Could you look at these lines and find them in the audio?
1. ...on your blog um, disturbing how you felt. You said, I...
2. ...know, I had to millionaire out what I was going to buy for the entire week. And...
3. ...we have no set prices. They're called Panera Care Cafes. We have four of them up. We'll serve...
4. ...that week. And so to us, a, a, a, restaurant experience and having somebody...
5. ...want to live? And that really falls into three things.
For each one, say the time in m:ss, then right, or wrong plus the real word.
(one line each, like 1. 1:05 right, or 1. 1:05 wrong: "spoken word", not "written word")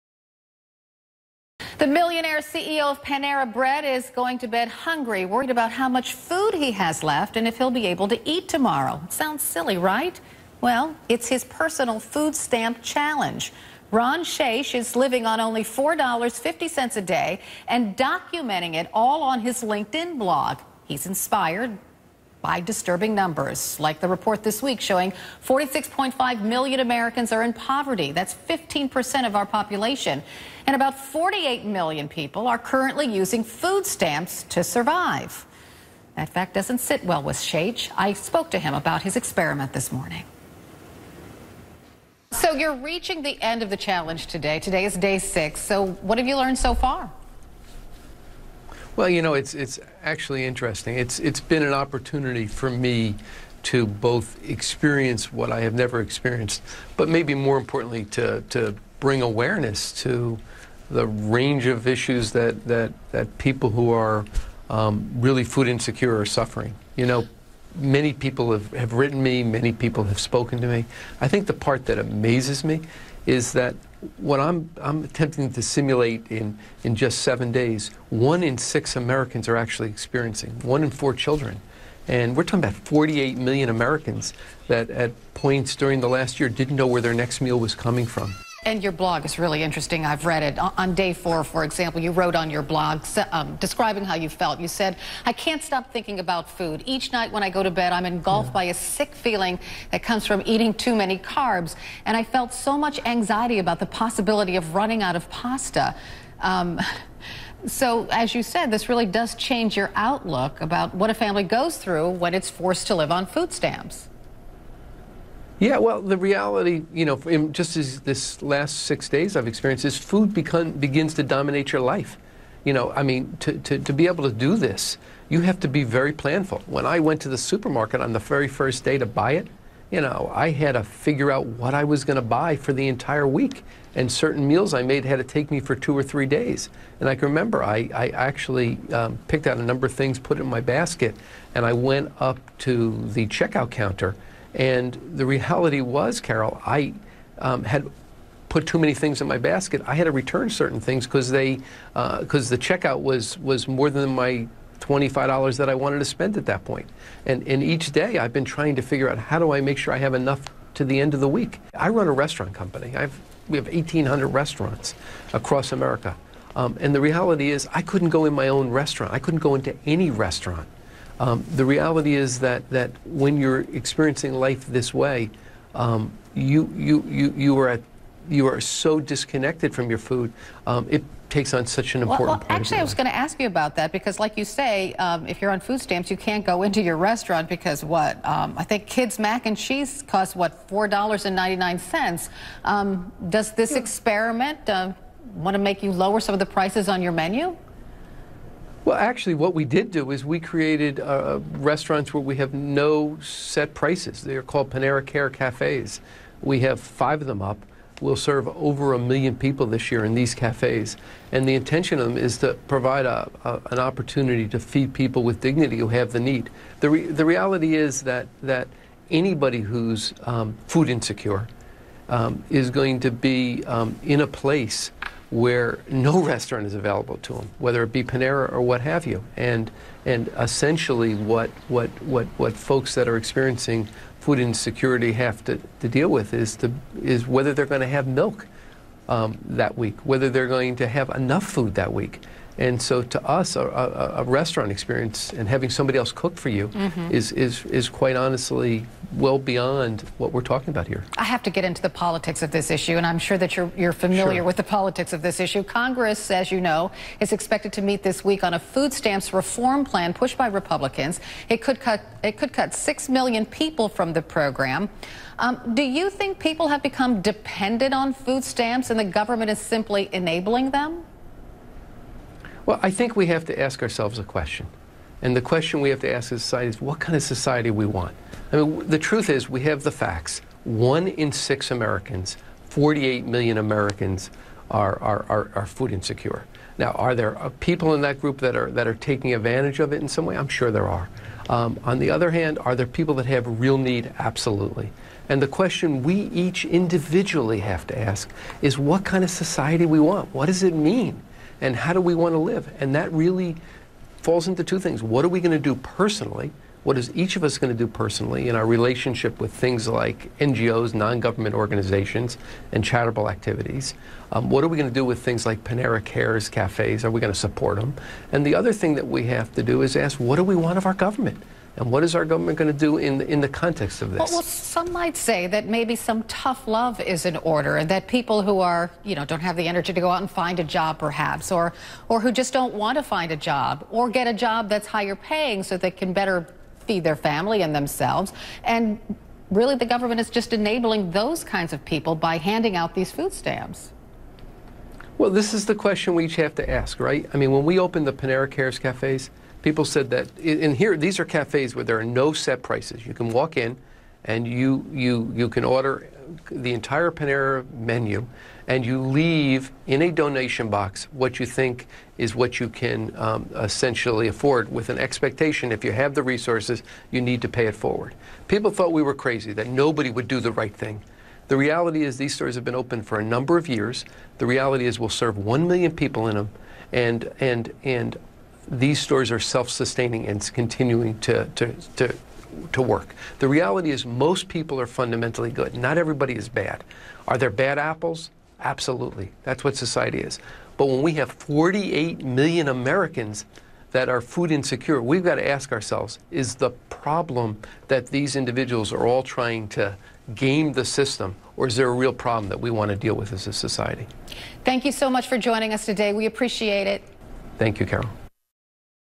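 1. 1:32 wrong: "describing", not "disturbing"
2. 2:10 wrong: "figure", not "millionaire"
3. 3:22 wrong: "five", not "four"
4. 4:01 right
5. 5:02 wrong: "two", not "three".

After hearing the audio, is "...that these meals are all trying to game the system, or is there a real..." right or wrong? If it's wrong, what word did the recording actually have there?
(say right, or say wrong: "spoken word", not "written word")
wrong: "individuals", not "meals".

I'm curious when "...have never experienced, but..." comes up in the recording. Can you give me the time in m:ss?
0:55.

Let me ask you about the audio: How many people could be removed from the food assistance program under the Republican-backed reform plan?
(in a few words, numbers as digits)
6 million.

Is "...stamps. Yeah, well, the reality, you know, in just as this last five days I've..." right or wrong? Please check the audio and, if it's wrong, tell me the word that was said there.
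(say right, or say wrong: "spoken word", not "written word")
wrong: "six", not "five".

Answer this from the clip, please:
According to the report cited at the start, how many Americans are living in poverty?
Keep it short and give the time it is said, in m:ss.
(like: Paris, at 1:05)
46.5 million, at 0:25.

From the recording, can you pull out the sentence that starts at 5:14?
Um, what are we going to do with things like Panera Cares cafes?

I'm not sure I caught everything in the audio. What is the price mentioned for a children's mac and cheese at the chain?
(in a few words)
$4.99.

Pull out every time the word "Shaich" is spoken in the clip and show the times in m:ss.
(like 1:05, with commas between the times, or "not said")
0:14, 0:37.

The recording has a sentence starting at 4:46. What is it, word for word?
Now, are there uh, people in that group that are, that are taking advantage of it in some way?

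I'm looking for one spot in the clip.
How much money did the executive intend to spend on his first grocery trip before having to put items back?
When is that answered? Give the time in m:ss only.
2:34.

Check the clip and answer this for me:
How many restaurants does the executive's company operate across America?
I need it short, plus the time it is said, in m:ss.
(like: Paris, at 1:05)
1,800, at 2:43.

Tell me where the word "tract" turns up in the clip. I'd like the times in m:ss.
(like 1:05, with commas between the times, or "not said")
not said.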